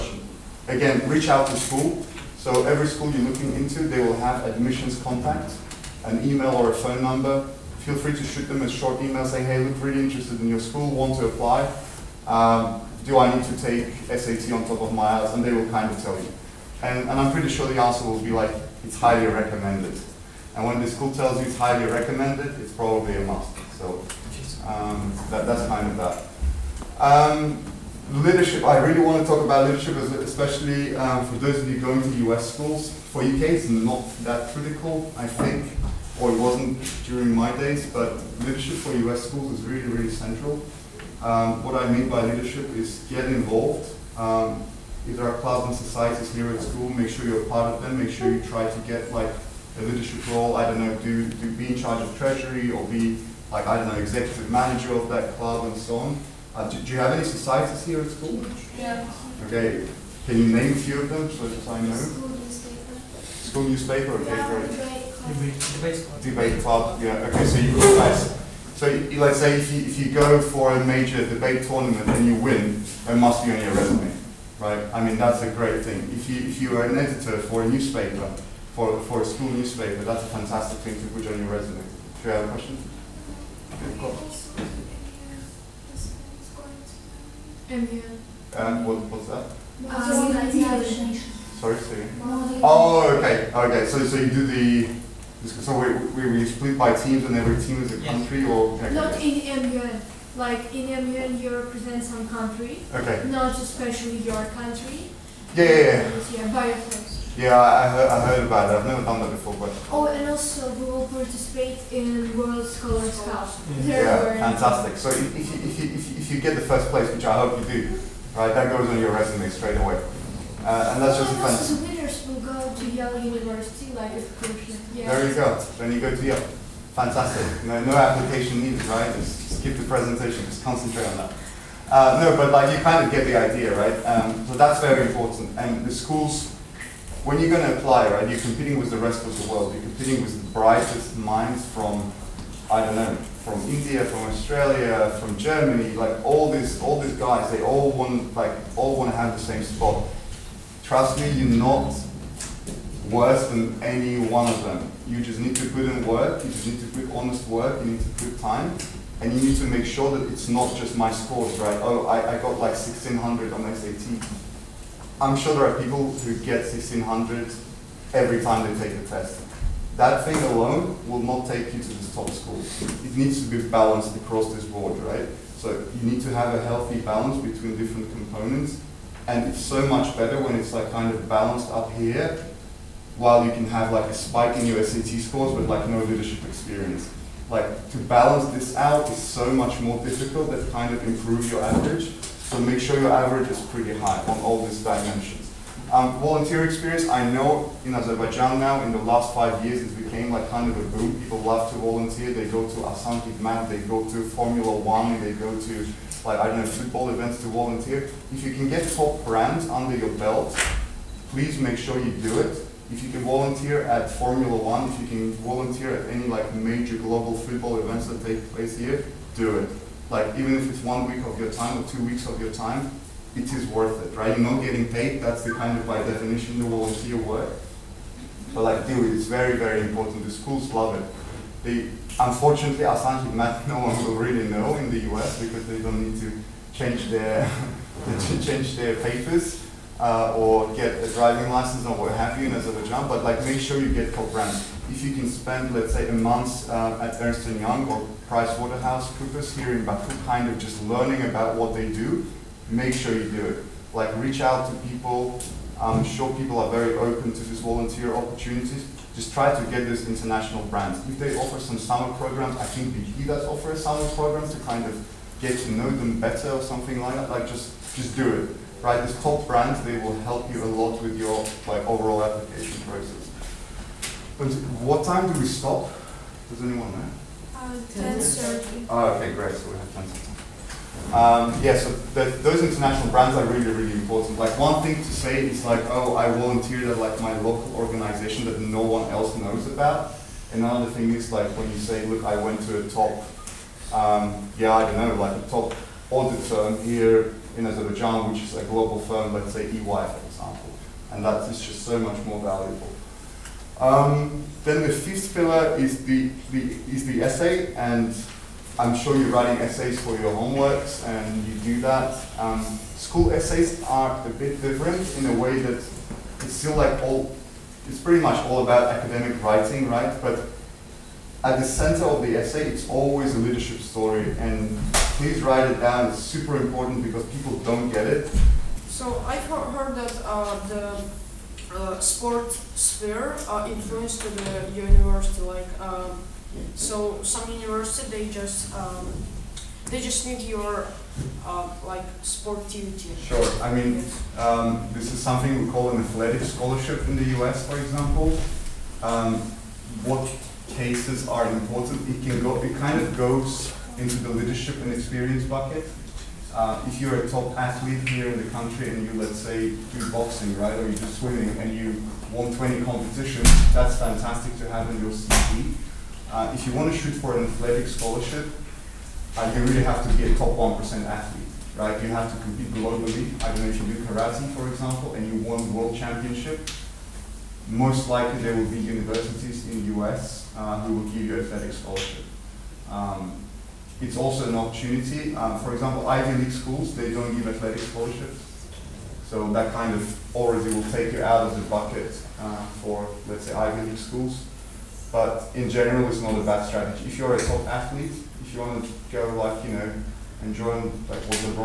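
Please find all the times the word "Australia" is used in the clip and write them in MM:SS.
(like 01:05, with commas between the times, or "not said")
02:24.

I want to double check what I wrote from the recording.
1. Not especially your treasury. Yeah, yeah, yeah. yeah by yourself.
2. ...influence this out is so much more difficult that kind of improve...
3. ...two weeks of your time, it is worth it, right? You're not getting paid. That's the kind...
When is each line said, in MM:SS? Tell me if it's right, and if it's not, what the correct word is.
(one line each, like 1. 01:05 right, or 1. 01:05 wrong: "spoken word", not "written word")
1. 01:43 wrong: "country", not "treasury"
2. 03:07 wrong: "balance", not "influence"
3. 03:41 right.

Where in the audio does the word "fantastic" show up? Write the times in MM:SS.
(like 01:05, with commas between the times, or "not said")
01:20, 01:54, 02:01, 02:06, 06:03.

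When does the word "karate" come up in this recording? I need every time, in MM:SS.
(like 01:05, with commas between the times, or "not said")
06:14.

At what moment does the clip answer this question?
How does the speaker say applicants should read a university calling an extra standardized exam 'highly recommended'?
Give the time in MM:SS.
00:22.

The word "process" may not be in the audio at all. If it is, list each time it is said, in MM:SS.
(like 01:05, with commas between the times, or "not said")
04:32.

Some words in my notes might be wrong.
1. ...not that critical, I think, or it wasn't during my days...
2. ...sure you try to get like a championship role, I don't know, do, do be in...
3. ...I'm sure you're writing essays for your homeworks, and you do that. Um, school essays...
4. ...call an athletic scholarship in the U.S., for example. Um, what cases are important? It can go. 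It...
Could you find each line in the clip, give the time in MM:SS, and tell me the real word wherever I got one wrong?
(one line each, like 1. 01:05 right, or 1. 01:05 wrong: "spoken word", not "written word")
1. 00:33 right
2. 00:48 wrong: "leadership", not "championship"
3. 05:08 right
4. 05:45 right.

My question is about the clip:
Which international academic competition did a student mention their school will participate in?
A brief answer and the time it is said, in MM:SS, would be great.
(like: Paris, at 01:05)
World Scholars Cup, at 01:52.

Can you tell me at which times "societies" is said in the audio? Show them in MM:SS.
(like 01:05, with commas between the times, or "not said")
00:45, 00:57.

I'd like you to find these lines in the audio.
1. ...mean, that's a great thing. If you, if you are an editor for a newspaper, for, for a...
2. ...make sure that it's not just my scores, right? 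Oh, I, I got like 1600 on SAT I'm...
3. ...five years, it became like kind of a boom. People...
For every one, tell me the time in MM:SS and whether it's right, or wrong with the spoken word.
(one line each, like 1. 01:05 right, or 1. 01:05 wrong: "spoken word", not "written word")
1. 01:15 right
2. 02:39 right
3. 03:19 right.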